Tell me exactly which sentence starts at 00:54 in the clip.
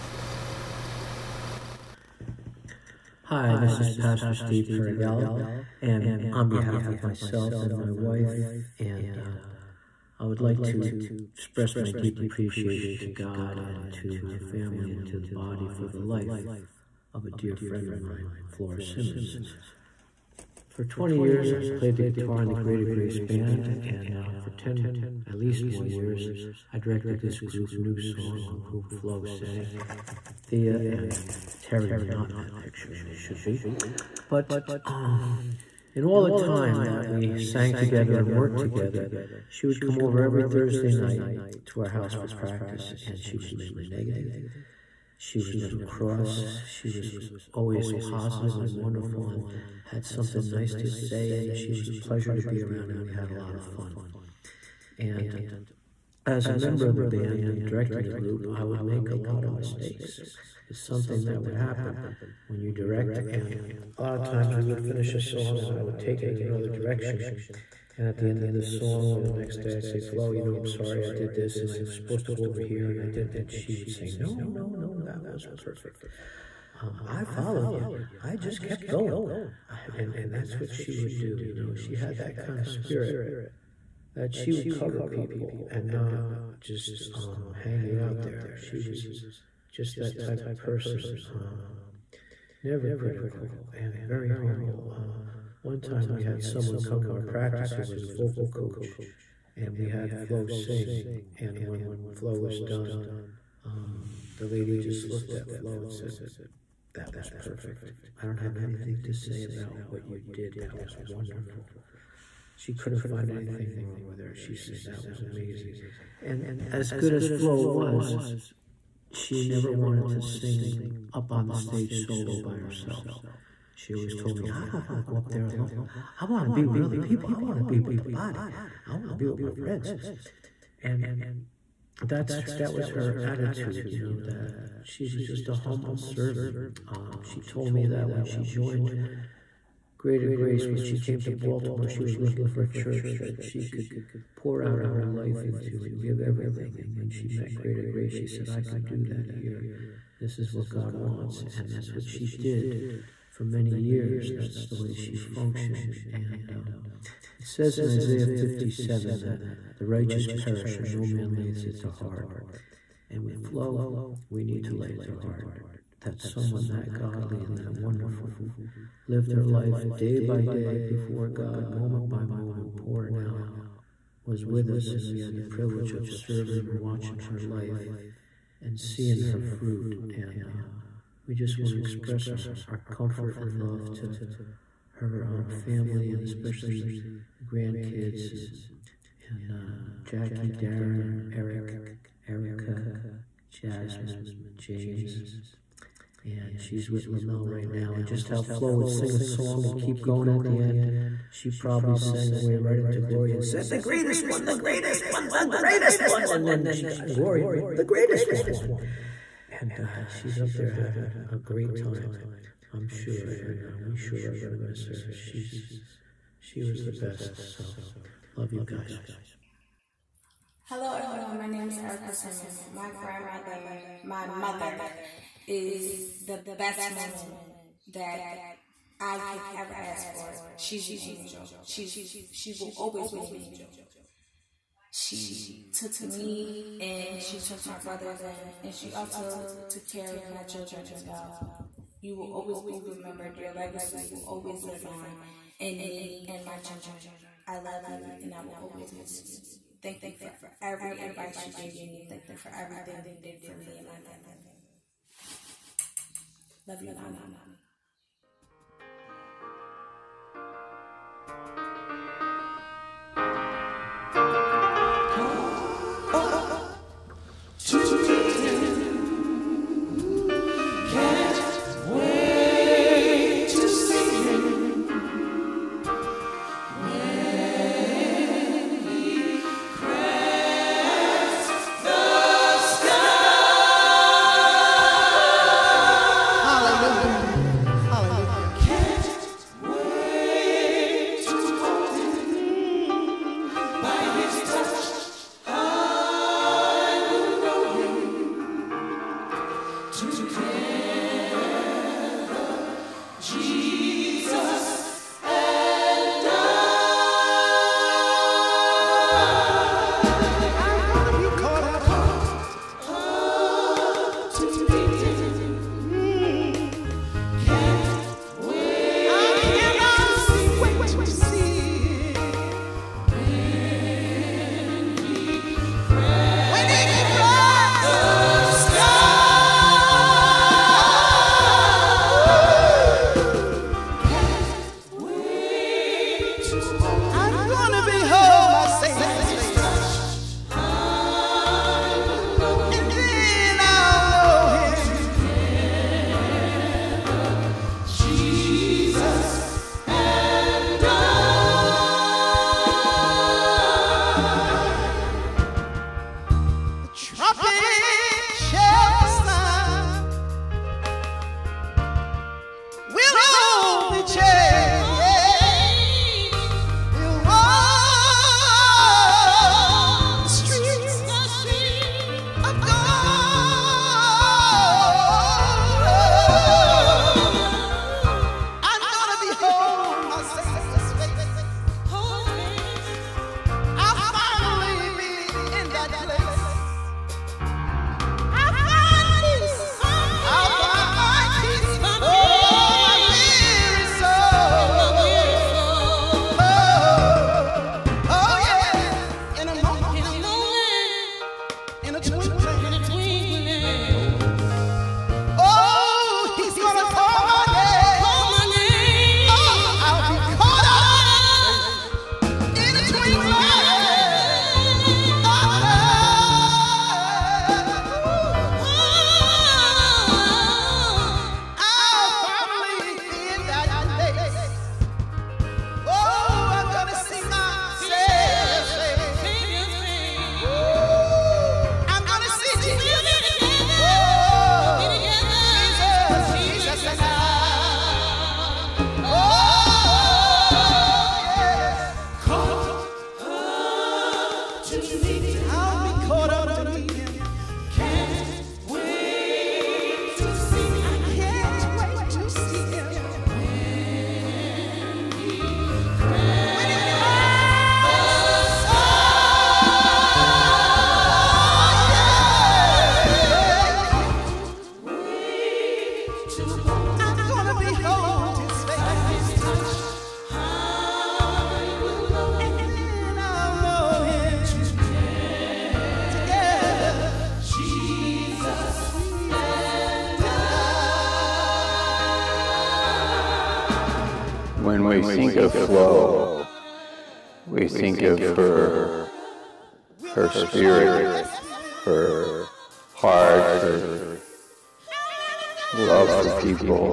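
And as a member of the band and directing the group, I would make a lot of mistakes.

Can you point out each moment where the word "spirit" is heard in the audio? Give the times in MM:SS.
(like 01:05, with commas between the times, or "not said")
01:22, 08:10.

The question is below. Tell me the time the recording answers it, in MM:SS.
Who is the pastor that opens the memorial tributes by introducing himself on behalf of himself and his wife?
00:04.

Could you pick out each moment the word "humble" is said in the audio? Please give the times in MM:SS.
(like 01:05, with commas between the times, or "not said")
01:34, 02:15.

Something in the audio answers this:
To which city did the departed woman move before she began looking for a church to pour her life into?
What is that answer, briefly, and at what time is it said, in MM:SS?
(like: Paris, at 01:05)
Baltimore, at 02:21.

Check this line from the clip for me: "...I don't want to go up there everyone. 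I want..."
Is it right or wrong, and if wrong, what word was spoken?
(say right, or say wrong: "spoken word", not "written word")
wrong: "alone", not "everyone".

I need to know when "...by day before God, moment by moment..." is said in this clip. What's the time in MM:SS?
02:50.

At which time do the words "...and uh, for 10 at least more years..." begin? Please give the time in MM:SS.
00:23.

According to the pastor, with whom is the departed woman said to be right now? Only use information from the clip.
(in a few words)
Lamel.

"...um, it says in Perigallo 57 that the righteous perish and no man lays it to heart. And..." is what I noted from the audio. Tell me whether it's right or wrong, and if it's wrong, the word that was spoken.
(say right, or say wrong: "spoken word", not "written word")
wrong: "Isaiah", not "Perigallo".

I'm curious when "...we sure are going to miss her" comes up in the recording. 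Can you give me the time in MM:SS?
03:33.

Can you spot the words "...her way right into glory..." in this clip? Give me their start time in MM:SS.
03:22.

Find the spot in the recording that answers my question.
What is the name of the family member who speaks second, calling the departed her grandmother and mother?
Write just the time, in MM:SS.
03:41.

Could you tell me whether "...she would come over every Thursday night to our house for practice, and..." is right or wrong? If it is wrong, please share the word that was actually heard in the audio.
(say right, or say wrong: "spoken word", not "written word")
right.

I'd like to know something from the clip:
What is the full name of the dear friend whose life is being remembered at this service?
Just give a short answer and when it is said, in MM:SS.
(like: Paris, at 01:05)
Flora Simmons, at 00:18.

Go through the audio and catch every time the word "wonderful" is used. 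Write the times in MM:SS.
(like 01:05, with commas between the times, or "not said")
00:48, 01:50, 02:47.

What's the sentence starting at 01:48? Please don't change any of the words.
I don't have anything to say about what you did.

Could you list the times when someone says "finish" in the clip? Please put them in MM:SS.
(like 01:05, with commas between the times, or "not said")
01:04.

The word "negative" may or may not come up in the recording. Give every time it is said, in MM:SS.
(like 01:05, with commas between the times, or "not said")
00:43.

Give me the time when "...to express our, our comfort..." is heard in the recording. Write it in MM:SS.
03:01.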